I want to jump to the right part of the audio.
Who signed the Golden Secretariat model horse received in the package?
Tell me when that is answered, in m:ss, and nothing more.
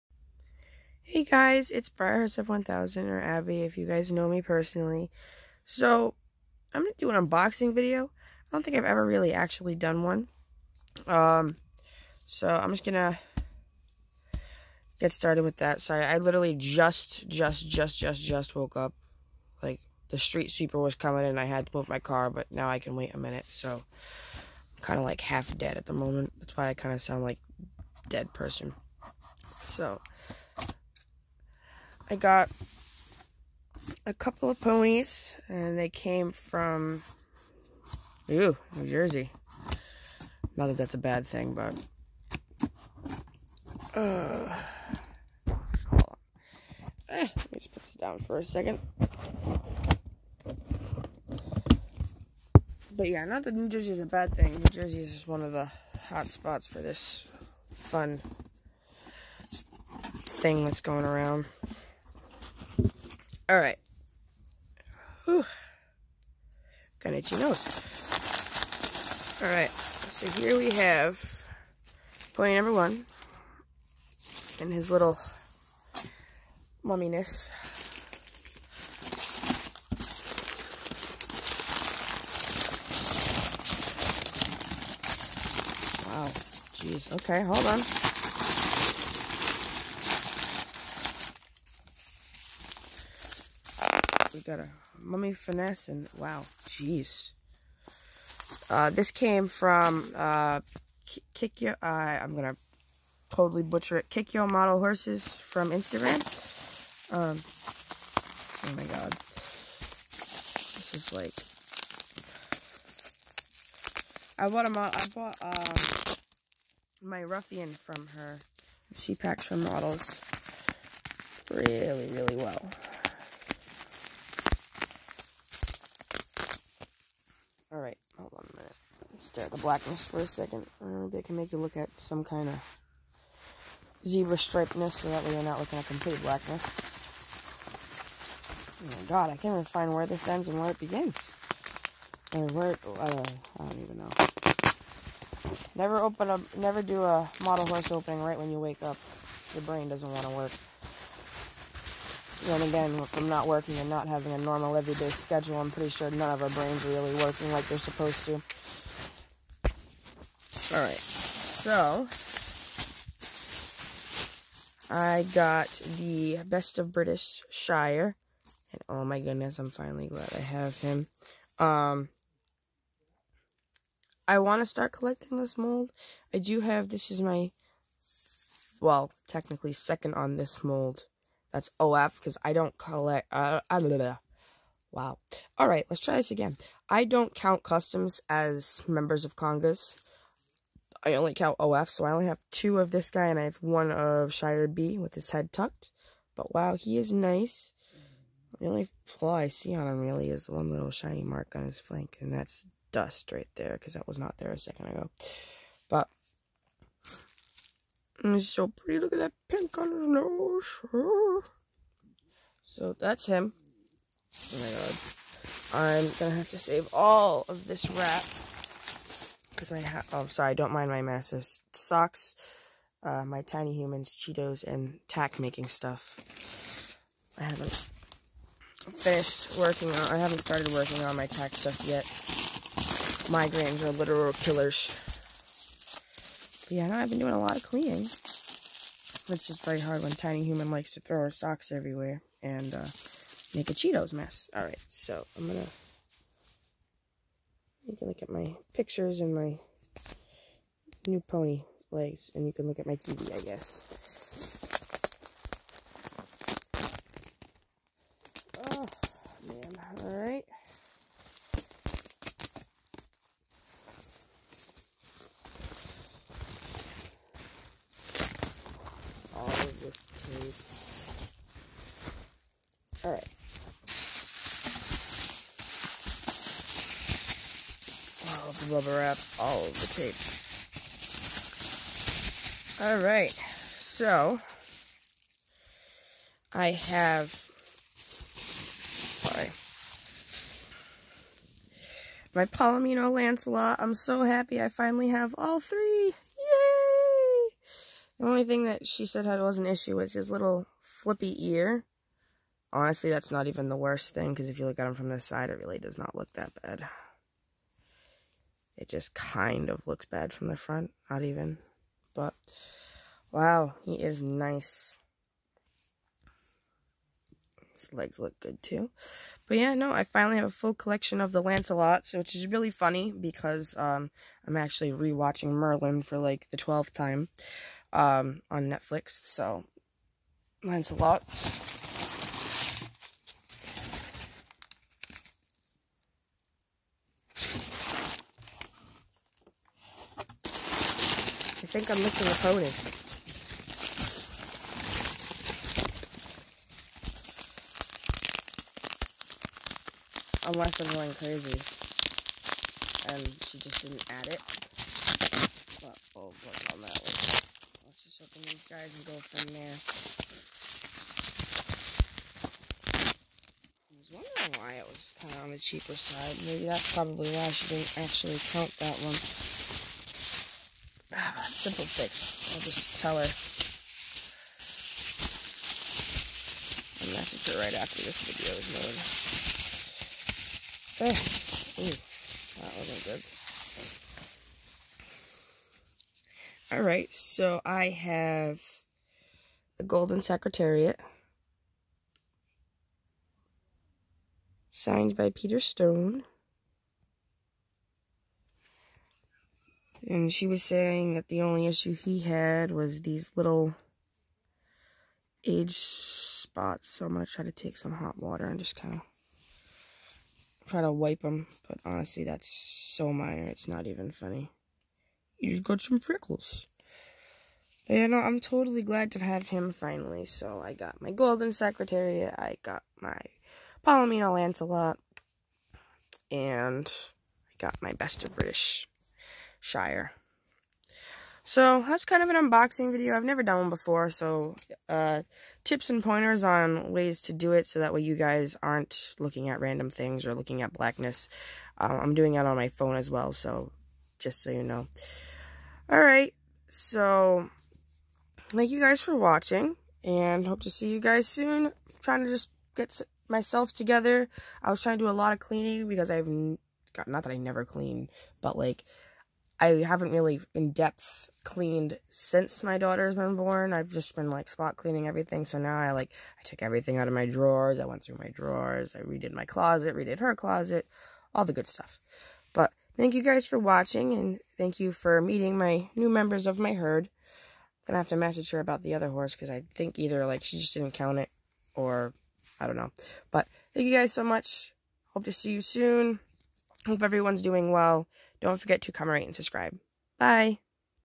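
6:35.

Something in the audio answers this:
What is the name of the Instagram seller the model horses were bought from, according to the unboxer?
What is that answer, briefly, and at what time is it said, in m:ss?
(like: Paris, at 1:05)
Kikyo Model Horses, at 1:44.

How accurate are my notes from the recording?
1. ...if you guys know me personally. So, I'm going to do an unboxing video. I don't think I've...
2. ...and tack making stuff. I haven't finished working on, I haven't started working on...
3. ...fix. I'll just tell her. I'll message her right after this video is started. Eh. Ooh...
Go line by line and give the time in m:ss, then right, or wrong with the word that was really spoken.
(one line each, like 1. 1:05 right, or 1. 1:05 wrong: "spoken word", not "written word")
1. 0:03 right
2. 3:44 right
3. 6:11 wrong: "loaded", not "started".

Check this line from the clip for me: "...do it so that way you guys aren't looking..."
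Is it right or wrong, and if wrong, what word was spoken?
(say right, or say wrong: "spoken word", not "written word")
right.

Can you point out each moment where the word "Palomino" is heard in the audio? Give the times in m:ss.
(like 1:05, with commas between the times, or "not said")
4:52, 7:03.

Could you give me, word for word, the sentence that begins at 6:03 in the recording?
I was wondering why it was kind of on the cheaper side.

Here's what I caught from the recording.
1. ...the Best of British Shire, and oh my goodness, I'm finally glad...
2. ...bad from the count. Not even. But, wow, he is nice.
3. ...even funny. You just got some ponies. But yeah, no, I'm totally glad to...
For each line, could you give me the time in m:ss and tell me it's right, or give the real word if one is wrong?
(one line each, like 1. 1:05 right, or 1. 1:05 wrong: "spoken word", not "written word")
1. 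2:45 right
2. 5:10 wrong: "front", not "count"
3. 6:53 wrong: "freckles", not "ponies".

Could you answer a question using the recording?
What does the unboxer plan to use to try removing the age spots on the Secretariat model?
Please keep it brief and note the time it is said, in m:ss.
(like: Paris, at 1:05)
hot water, at 6:47.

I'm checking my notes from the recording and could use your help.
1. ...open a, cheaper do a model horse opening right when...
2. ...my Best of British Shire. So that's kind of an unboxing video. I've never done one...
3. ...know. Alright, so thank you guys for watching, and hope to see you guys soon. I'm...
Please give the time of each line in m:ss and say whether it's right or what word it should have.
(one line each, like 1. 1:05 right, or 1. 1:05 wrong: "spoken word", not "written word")
1. 2:26 wrong: "never", not "cheaper"
2. 7:07 right
3. 7:24 right.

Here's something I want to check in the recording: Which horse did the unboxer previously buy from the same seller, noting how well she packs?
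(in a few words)
Ruffian.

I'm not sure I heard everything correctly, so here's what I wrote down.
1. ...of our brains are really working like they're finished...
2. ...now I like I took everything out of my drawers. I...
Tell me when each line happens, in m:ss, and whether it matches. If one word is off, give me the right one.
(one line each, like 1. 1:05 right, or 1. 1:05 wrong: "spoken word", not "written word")
1. 2:36 wrong: "supposed", not "finished"
2. 7:45 right.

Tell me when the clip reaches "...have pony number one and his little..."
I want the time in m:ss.
1:10.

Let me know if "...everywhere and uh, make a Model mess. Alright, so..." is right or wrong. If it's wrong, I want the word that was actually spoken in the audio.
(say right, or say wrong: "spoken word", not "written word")
wrong: "Cheetos", not "Model".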